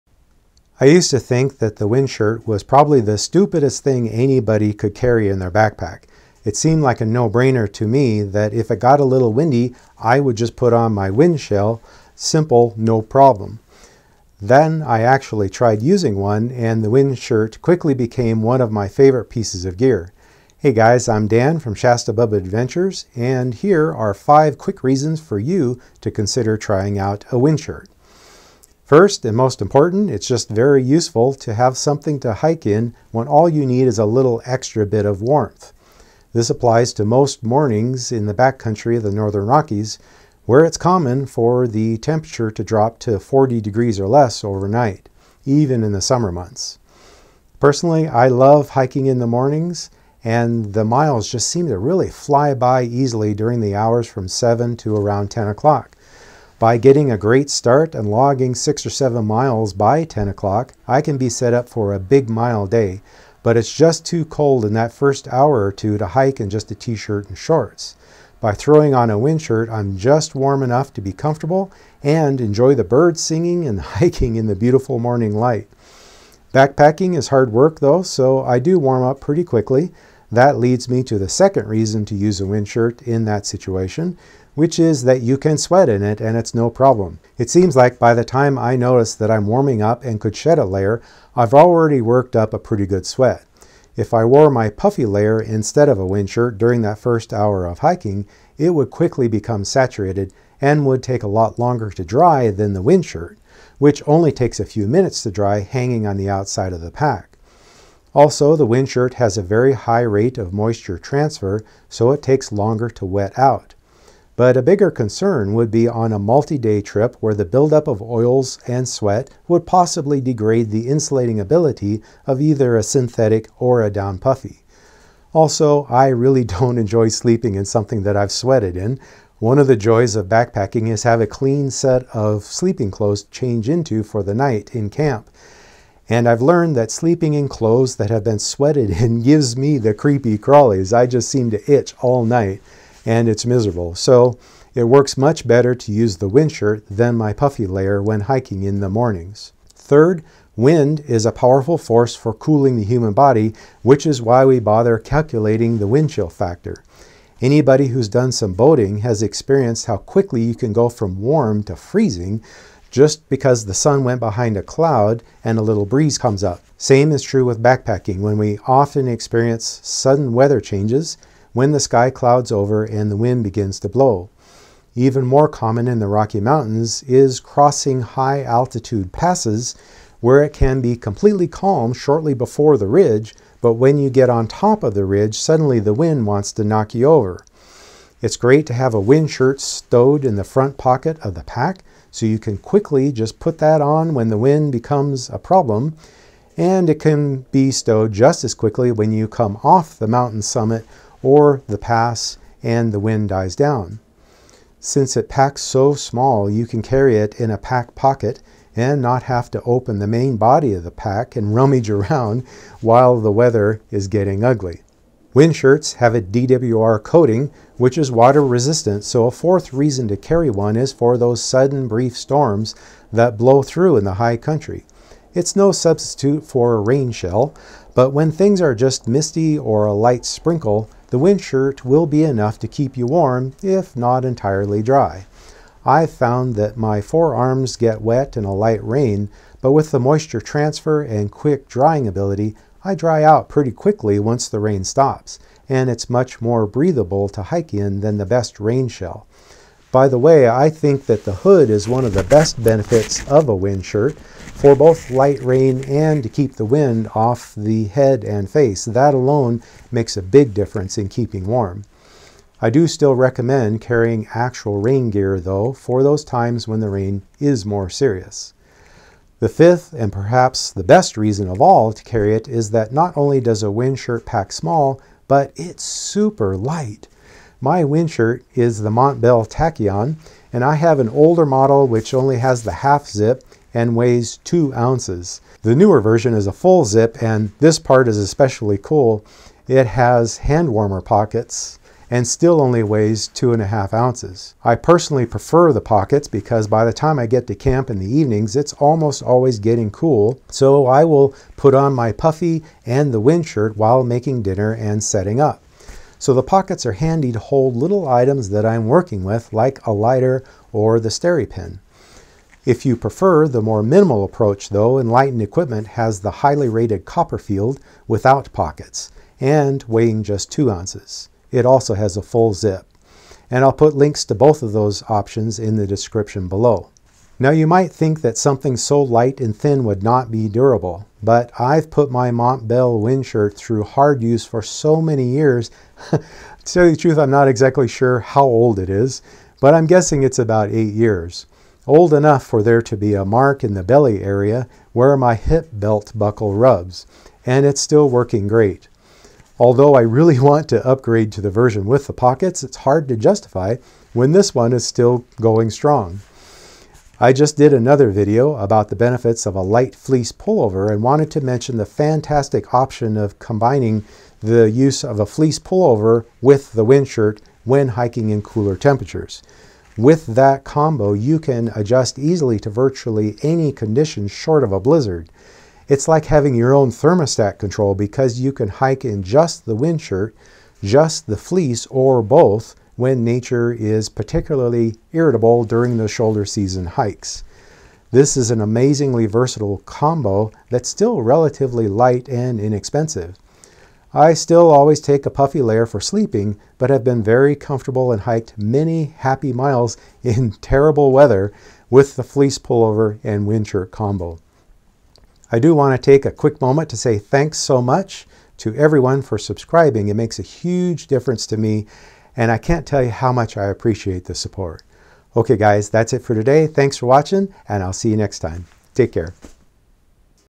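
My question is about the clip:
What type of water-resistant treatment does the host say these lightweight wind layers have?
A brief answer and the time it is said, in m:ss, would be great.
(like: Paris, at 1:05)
DWR coating, at 3:36.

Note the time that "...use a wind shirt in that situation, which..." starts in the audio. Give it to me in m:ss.
1:22.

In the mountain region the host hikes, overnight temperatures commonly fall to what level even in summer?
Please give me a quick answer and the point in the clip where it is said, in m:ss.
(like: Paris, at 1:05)
40 degrees, at 0:43.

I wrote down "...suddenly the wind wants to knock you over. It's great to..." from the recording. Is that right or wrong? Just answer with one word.
right.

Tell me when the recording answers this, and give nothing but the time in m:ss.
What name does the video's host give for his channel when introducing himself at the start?
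0:21.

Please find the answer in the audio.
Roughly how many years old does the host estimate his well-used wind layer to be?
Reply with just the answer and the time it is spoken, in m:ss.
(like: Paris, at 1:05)
8, at 5:40.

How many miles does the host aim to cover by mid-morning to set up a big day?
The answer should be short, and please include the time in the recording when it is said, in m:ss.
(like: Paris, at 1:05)
six or seven miles, at 0:58.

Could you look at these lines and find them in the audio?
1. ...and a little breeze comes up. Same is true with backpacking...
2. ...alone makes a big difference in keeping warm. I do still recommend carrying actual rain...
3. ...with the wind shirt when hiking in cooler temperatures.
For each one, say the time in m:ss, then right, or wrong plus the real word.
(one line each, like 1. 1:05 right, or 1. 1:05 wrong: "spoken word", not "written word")
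1. 2:45 right
2. 4:19 right
3. 6:06 right.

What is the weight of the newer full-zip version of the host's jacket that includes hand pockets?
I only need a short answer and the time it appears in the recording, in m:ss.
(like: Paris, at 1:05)
2.5 ounces, at 4:53.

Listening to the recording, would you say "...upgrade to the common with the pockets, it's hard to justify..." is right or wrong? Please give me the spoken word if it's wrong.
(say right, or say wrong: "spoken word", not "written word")
wrong: "version", not "common".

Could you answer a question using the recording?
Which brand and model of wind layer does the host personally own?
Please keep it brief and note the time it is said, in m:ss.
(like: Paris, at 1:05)
Montbell Tachyon, at 4:38.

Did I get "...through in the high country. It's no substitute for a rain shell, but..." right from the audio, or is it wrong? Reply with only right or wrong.
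right.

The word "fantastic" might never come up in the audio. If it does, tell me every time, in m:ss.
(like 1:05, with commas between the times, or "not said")
6:01.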